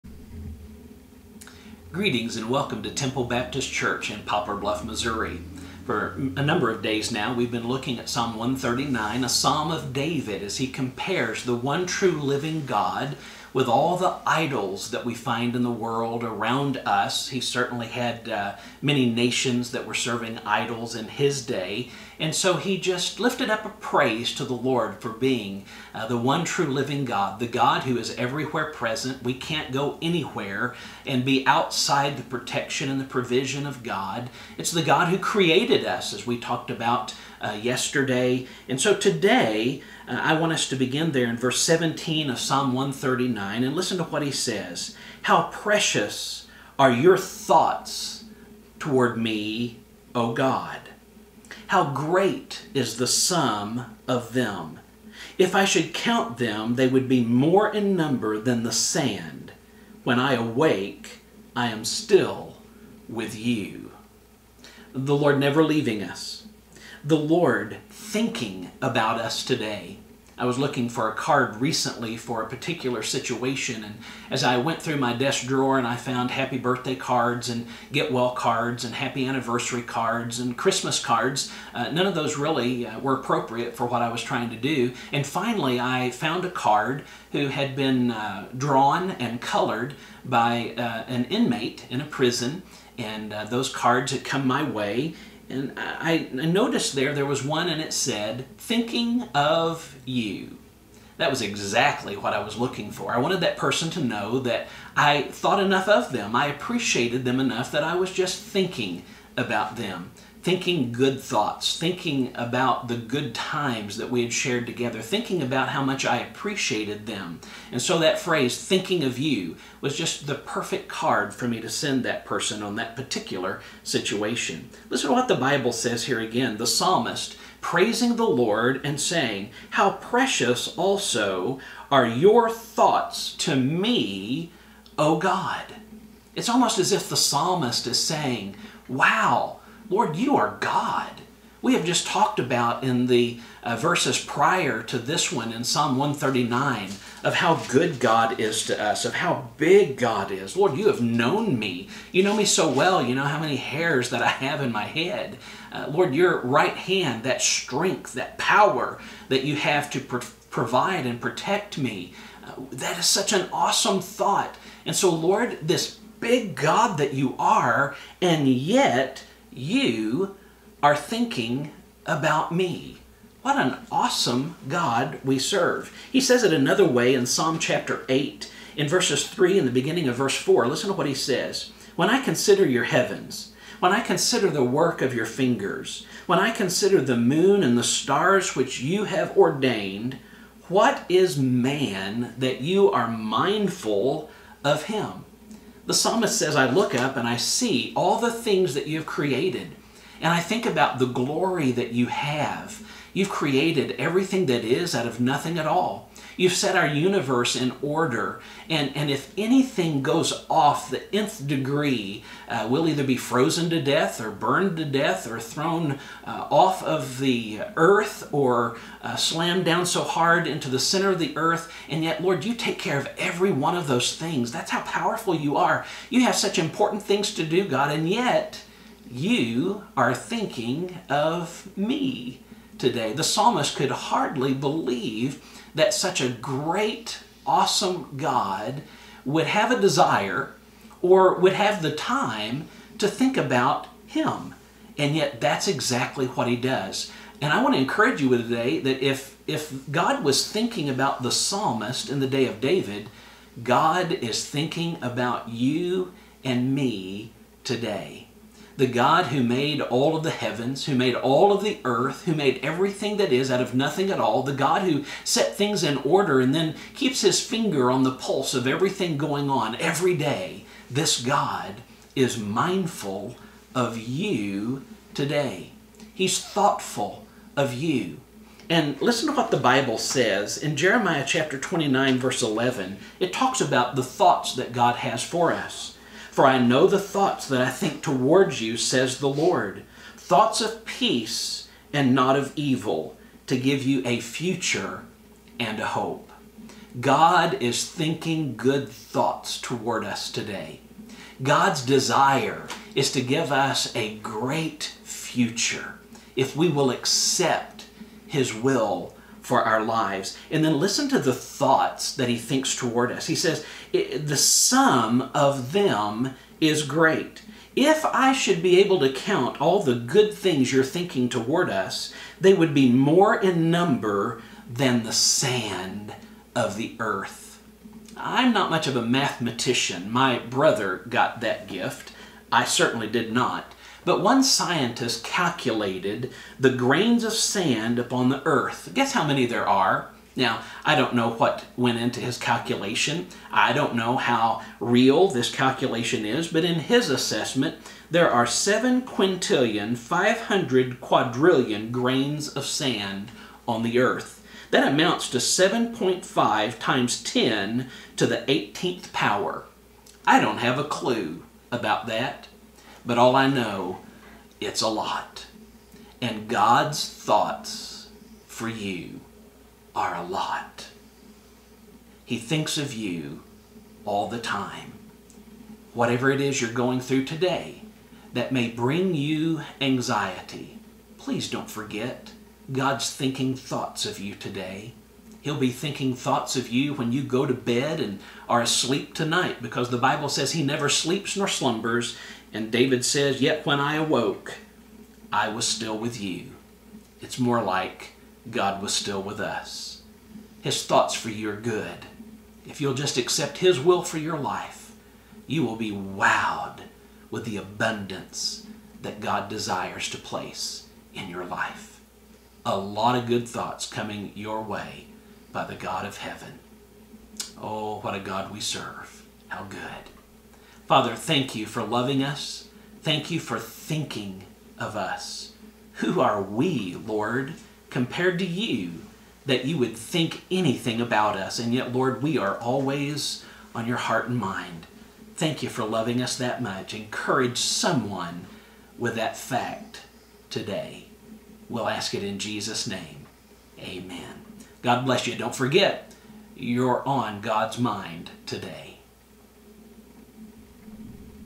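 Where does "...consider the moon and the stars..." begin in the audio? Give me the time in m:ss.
3:06.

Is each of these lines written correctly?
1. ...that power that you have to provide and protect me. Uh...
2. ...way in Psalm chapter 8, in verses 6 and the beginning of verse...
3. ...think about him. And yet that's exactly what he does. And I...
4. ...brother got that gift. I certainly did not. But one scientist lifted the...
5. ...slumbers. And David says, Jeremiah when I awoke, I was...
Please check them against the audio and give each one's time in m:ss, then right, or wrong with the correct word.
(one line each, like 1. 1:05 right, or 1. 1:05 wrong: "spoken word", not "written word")
1. 2:38 right
2. 2:56 wrong: "3", not "6"
3. 4:03 right
4. 5:30 wrong: "calculated", not "lifted"
5. 6:31 wrong: "Yet", not "Jeremiah".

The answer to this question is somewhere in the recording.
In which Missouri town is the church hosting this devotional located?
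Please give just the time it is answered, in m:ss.
0:04.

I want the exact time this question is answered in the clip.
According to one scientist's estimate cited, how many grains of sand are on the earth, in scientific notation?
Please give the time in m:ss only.
5:55.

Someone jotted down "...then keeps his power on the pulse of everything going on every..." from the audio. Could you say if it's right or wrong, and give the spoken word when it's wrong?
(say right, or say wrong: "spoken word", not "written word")
wrong: "finger", not "power".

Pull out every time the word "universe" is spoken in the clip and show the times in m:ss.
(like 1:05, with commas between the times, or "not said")
3:26.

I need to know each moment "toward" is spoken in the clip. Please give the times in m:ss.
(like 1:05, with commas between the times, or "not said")
0:48, 4:48, 4:59, 5:12, 5:21.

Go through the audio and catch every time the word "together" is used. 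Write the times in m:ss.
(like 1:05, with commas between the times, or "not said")
1:54.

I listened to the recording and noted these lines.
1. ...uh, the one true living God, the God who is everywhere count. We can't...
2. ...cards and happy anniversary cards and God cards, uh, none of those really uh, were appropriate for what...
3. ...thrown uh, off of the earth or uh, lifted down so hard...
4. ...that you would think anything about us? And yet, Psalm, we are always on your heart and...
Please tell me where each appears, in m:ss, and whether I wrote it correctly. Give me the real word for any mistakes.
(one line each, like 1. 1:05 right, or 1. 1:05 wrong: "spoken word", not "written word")
1. 0:25 wrong: "present", not "count"
2. 1:18 wrong: "Christmas", not "God"
3. 3:35 wrong: "slammed", not "lifted"
4. 7:09 wrong: "Lord", not "Psalm".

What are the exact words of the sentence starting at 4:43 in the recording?
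It talks about the thoughts that God has for us.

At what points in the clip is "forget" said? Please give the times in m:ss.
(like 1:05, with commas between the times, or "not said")
6:21, 7:25.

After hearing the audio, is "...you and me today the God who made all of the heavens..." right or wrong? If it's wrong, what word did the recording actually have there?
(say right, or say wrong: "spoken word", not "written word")
right.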